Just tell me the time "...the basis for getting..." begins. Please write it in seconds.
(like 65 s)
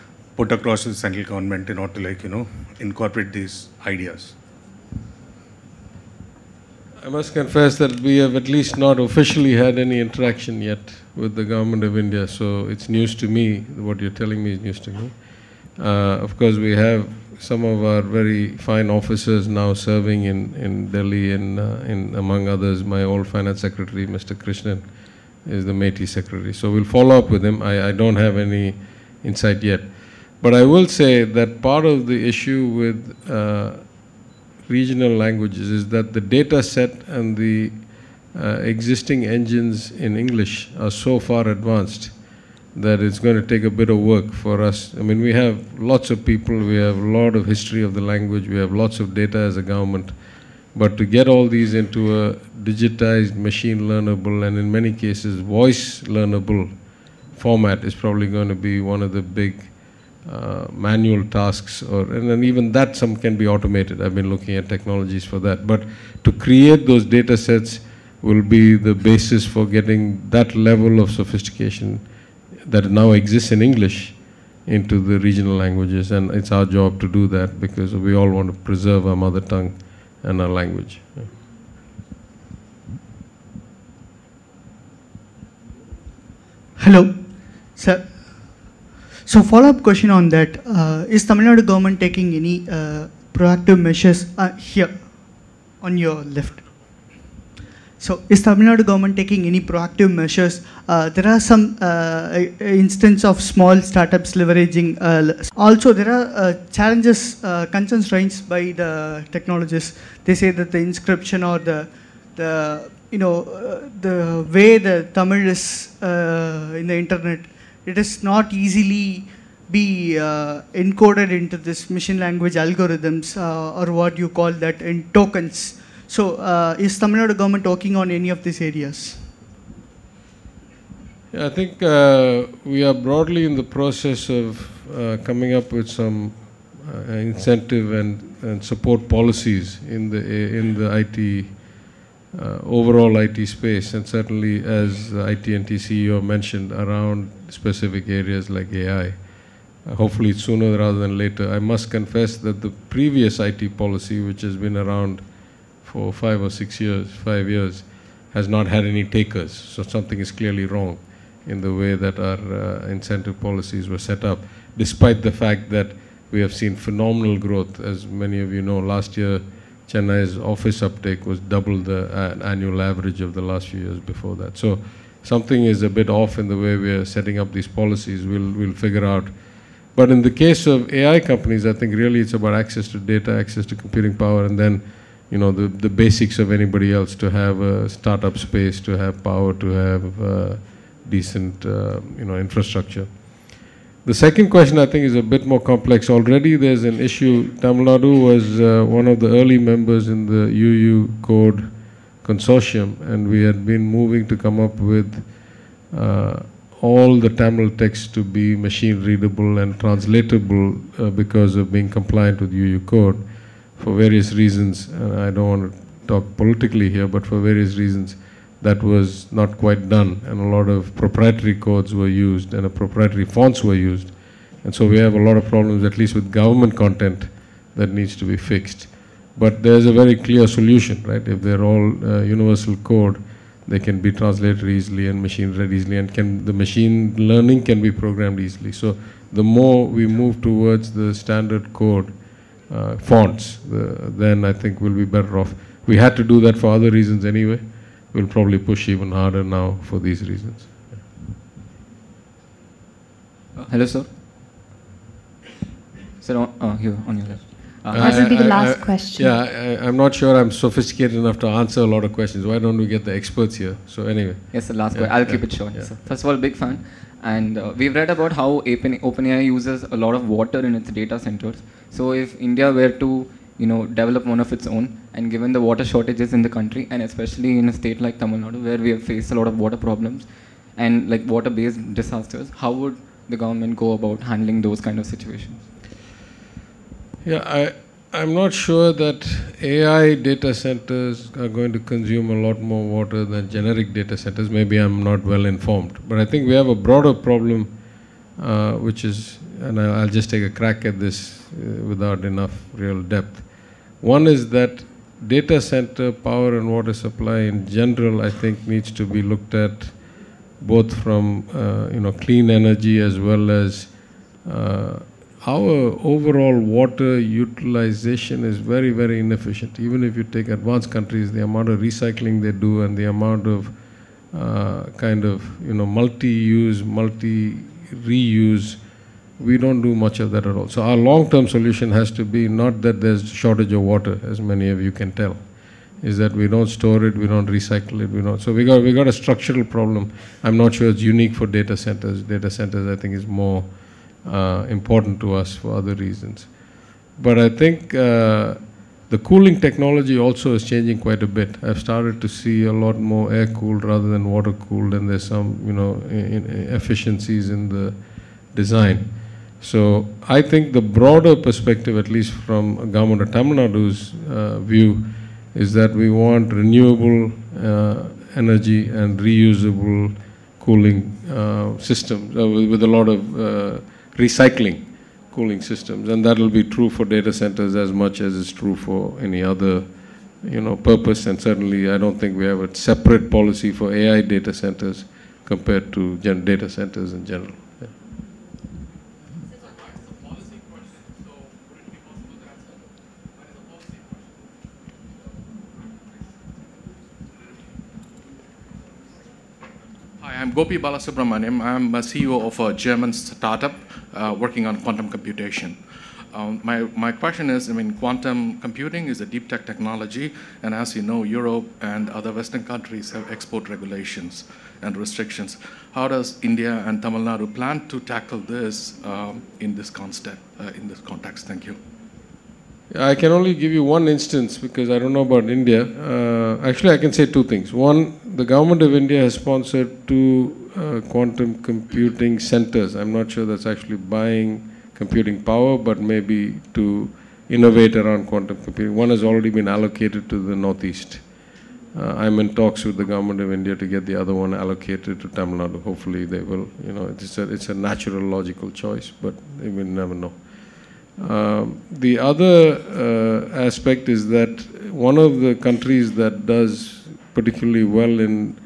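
68 s.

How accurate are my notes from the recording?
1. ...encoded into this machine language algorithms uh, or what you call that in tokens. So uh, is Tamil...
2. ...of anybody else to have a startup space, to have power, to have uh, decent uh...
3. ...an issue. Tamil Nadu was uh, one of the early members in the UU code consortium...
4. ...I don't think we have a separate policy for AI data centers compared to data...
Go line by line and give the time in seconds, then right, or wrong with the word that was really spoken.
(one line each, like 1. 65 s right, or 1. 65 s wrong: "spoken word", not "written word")
1. 120 s right
2. 186 s right
3. 196 s right
4. 381 s right.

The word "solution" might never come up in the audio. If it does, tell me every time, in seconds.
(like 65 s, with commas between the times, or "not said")
230 s, 331 s.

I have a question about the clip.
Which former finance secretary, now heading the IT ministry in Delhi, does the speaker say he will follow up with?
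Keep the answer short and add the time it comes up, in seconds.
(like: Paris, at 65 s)
Mr. Krishnan, at 24 s.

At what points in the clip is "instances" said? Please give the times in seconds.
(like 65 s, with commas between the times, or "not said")
102 s, 424 s.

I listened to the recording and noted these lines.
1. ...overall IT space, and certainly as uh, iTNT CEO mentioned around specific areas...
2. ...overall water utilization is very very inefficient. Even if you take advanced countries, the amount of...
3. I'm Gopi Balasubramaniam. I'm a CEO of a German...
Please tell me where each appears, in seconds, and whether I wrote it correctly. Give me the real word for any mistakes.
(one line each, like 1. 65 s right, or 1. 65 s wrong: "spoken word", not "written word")
1. 142 s right
2. 316 s right
3. 400 s right.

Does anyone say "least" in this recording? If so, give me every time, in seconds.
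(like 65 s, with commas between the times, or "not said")
8 s, 225 s, 362 s.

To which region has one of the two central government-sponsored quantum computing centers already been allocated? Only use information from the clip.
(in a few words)
The Northeast.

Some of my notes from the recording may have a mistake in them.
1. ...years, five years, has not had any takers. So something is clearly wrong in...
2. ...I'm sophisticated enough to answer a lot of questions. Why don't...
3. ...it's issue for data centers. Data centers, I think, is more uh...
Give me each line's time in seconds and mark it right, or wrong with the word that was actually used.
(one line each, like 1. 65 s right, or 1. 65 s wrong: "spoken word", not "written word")
1. 156 s right
2. 260 s right
3. 340 s wrong: "unique", not "issue".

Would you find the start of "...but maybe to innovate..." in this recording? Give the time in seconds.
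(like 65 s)
435 s.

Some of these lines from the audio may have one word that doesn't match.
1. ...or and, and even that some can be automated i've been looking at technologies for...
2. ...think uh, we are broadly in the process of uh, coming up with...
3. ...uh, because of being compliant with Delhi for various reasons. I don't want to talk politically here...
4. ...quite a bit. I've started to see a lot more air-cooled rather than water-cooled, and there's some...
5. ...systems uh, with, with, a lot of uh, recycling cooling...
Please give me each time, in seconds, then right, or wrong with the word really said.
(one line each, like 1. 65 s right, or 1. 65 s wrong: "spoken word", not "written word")
1. 61 s right
2. 131 s right
3. 210 s wrong: "Unicode", not "Delhi"
4. 350 s right
5. 371 s right.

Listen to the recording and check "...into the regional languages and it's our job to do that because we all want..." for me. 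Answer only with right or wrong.
right.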